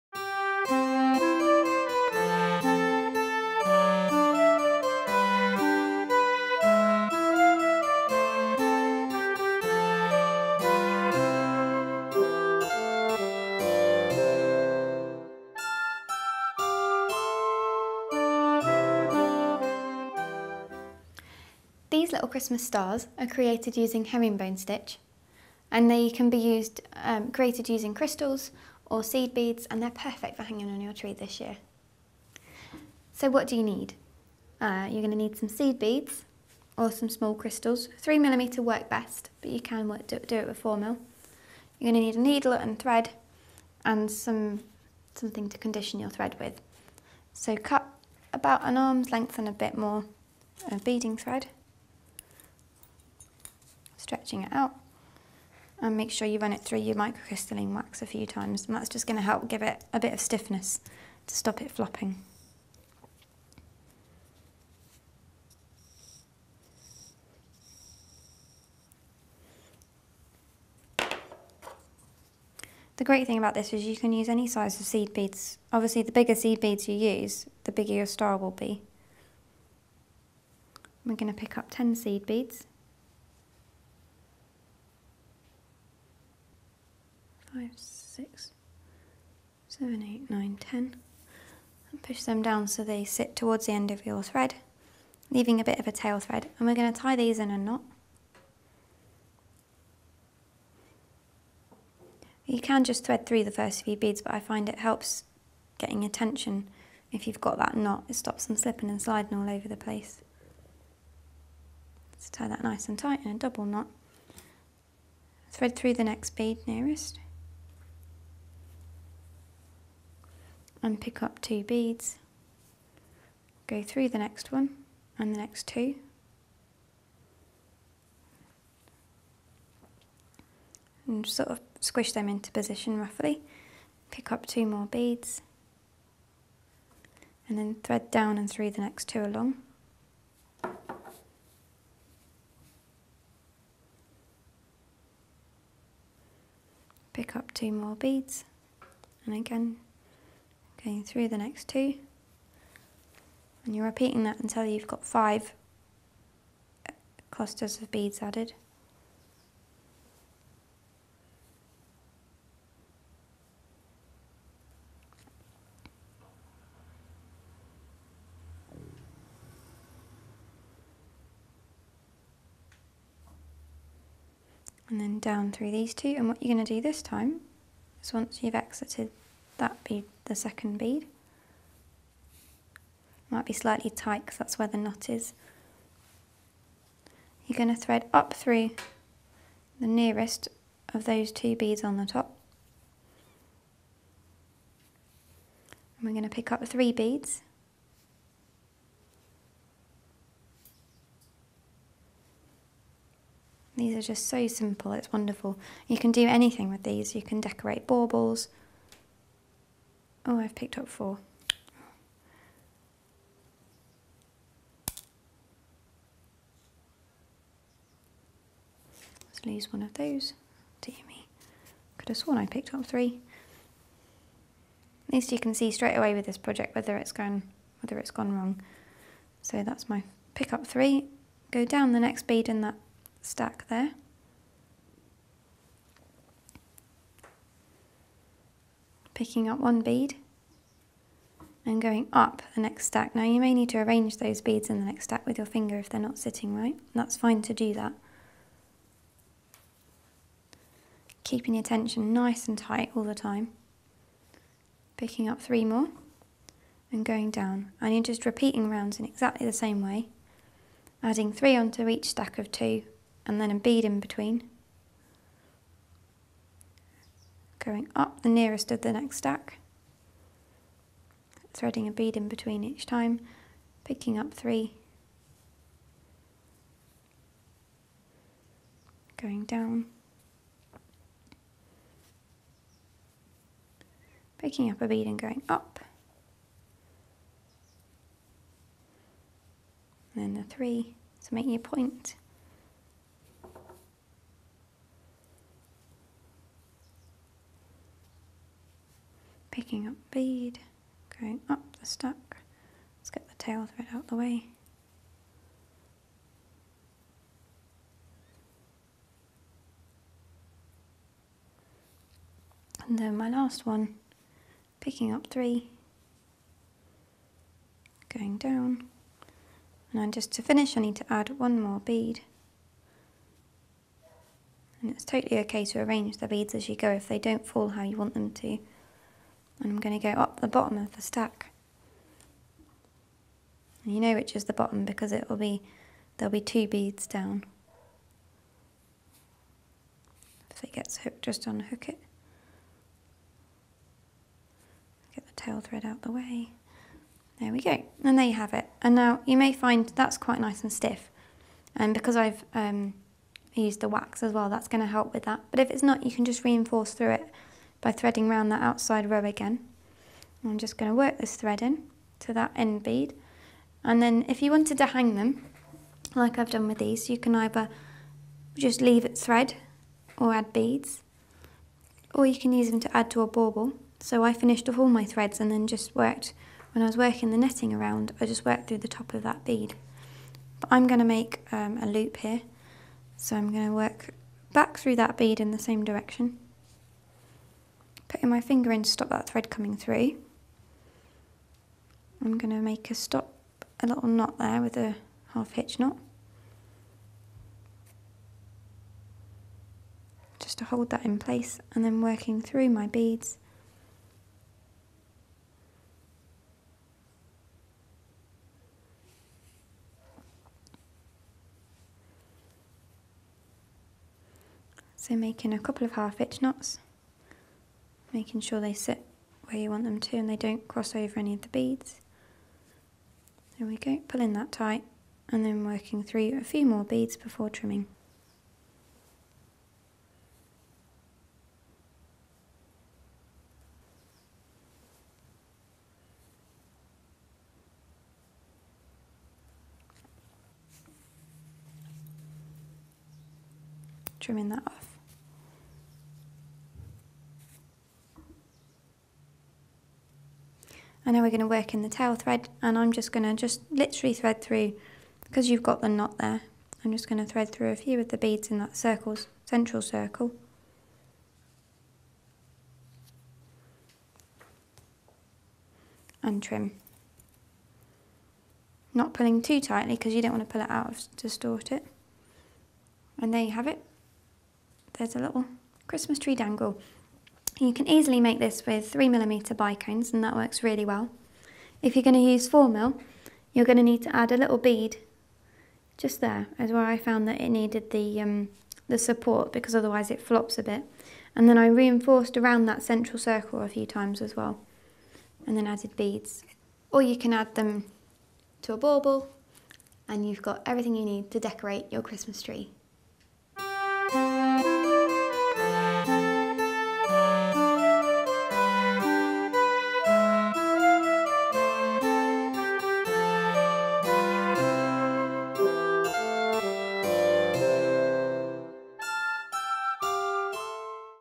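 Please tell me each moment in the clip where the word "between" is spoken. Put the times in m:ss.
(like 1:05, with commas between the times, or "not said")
4:23, 4:32.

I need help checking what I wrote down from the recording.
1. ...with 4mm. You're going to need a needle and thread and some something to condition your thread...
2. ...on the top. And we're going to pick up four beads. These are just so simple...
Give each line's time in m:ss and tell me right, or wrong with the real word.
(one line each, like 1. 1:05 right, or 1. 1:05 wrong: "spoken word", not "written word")
1. 0:40 right
2. 3:11 wrong: "three", not "four".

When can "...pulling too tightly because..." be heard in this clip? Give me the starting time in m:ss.
7:49.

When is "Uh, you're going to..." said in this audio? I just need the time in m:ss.
0:34.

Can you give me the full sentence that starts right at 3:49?
So that's my pick up three.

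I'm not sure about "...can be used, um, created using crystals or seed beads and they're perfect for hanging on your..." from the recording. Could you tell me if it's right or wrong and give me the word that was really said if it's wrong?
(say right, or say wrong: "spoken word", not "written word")
right.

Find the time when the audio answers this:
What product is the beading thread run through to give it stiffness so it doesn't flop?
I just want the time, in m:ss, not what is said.
0:56.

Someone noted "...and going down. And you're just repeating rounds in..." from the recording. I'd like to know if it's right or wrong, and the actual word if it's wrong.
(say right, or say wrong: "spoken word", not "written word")
right.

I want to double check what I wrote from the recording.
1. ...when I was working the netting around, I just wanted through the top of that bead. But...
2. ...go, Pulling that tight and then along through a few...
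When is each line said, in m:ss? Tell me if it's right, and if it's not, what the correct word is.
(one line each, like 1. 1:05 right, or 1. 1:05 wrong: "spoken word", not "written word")
1. 6:16 wrong: "worked", not "wanted"
2. 7:03 wrong: "working", not "along".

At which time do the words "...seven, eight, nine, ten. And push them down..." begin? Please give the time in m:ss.
1:29.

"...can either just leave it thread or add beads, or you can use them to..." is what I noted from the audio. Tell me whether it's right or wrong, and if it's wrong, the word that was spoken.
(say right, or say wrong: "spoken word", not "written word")
right.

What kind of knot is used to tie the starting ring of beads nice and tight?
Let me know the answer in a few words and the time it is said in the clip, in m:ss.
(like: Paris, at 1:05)
double knot, at 1:53.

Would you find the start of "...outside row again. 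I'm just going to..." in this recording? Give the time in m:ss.
5:58.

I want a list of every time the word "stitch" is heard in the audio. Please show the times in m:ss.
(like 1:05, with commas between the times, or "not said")
0:24.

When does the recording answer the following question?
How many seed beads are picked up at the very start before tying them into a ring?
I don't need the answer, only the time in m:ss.
1:21.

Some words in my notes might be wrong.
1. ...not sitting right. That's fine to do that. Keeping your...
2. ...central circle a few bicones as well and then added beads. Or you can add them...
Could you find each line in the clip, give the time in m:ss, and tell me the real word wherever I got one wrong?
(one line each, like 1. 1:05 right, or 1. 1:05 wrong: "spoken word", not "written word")
1. 4:06 right
2. 8:12 wrong: "times", not "bicones".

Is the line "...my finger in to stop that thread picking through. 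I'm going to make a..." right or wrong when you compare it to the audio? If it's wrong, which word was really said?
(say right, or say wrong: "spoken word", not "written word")
wrong: "coming", not "picking".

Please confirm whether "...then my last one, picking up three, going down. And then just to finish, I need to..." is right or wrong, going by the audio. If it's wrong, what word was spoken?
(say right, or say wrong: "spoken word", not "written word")
right.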